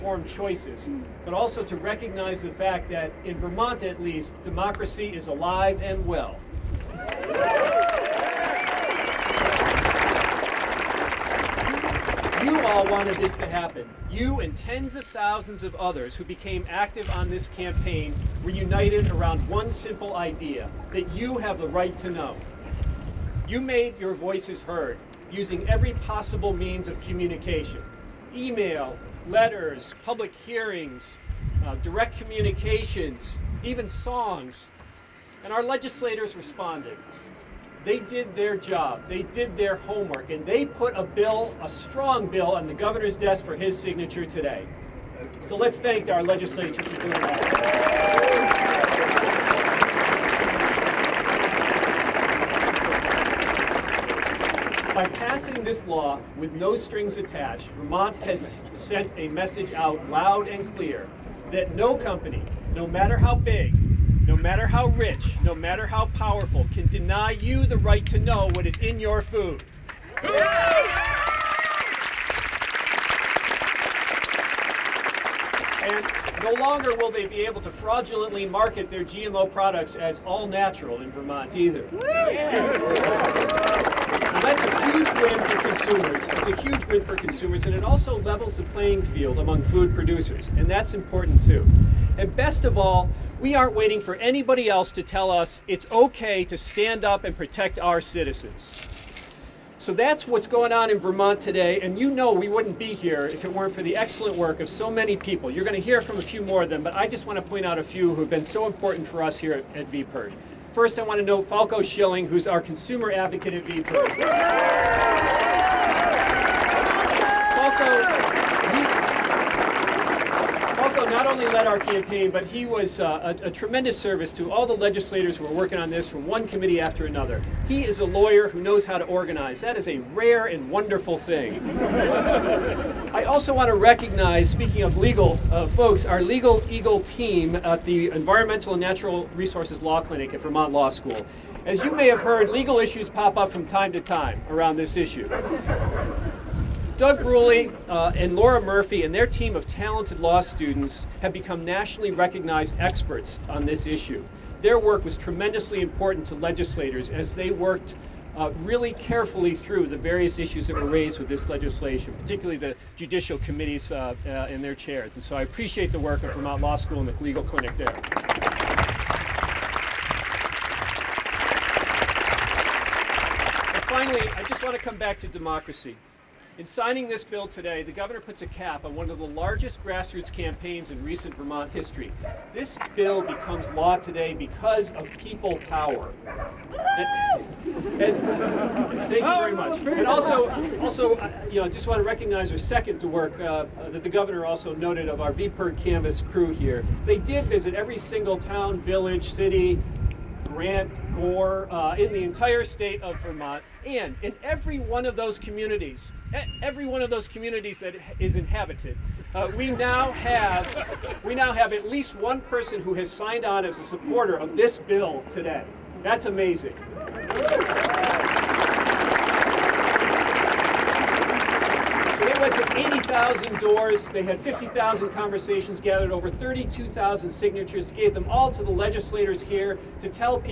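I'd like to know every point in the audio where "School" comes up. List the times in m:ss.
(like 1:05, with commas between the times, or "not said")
2:20, 2:46.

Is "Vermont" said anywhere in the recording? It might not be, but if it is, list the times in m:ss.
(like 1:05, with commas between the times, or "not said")
0:03, 0:57, 1:21, 1:40, 2:20, 2:46, 3:01, 3:23.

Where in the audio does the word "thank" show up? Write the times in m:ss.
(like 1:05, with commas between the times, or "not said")
0:45, 3:08.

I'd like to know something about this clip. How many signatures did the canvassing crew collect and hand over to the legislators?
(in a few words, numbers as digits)
over 32,000.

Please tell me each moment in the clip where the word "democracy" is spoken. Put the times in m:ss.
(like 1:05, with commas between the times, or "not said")
0:04, 2:55.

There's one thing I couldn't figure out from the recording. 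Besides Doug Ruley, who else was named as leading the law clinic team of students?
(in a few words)
Laura Murphy.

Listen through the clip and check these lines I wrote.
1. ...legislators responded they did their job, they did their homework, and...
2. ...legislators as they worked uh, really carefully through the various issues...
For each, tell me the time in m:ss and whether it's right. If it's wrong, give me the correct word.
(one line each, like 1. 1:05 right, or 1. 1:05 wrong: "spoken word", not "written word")
1. 0:35 right
2. 2:36 right.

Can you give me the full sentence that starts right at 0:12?
You all wanted this to happen.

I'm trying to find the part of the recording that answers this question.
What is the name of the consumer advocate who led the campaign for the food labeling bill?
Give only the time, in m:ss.
1:51.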